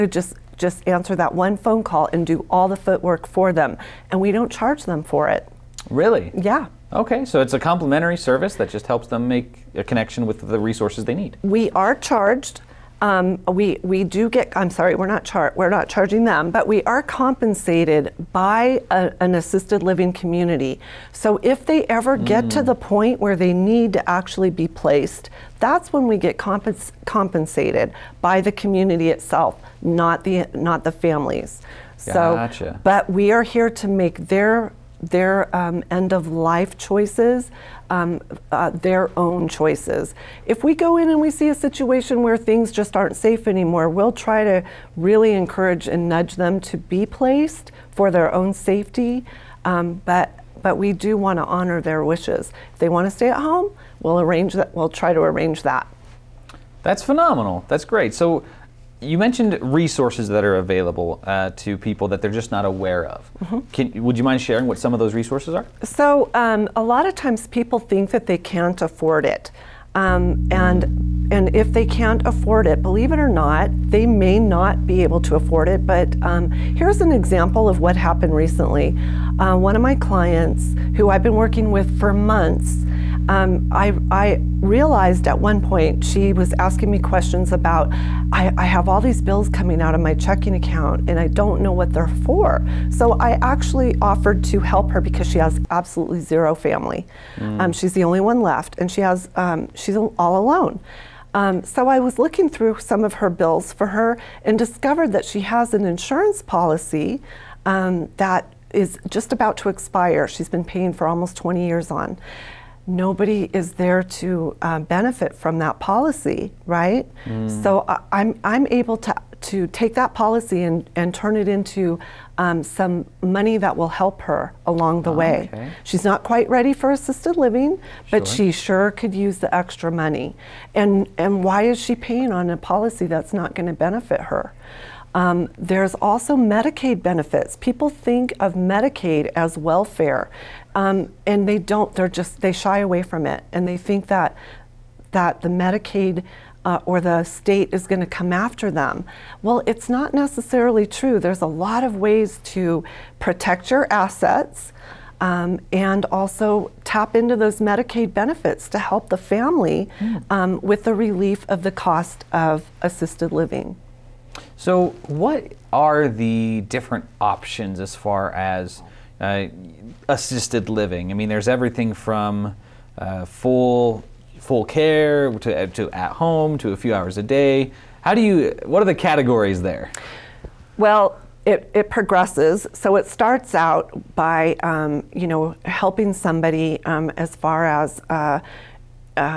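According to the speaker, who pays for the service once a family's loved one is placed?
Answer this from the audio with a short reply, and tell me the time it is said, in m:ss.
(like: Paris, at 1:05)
assisted living community, at 0:19.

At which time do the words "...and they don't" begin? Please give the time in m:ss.
2:21.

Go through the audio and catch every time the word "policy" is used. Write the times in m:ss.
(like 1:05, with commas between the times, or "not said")
1:46, 1:55, 2:00, 2:12.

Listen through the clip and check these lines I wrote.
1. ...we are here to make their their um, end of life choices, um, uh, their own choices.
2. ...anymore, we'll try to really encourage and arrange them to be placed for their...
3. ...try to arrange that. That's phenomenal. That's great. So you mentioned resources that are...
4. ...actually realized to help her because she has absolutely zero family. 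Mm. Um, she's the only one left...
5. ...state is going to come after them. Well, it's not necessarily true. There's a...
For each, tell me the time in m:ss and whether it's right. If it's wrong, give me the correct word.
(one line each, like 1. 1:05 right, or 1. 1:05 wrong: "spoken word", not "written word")
1. 0:33 right
2. 0:43 wrong: "nudge", not "arrange"
3. 0:54 right
4. 1:33 wrong: "offered", not "realized"
5. 2:27 right.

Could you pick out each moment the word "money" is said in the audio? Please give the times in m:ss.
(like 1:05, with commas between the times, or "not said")
2:03, 2:09.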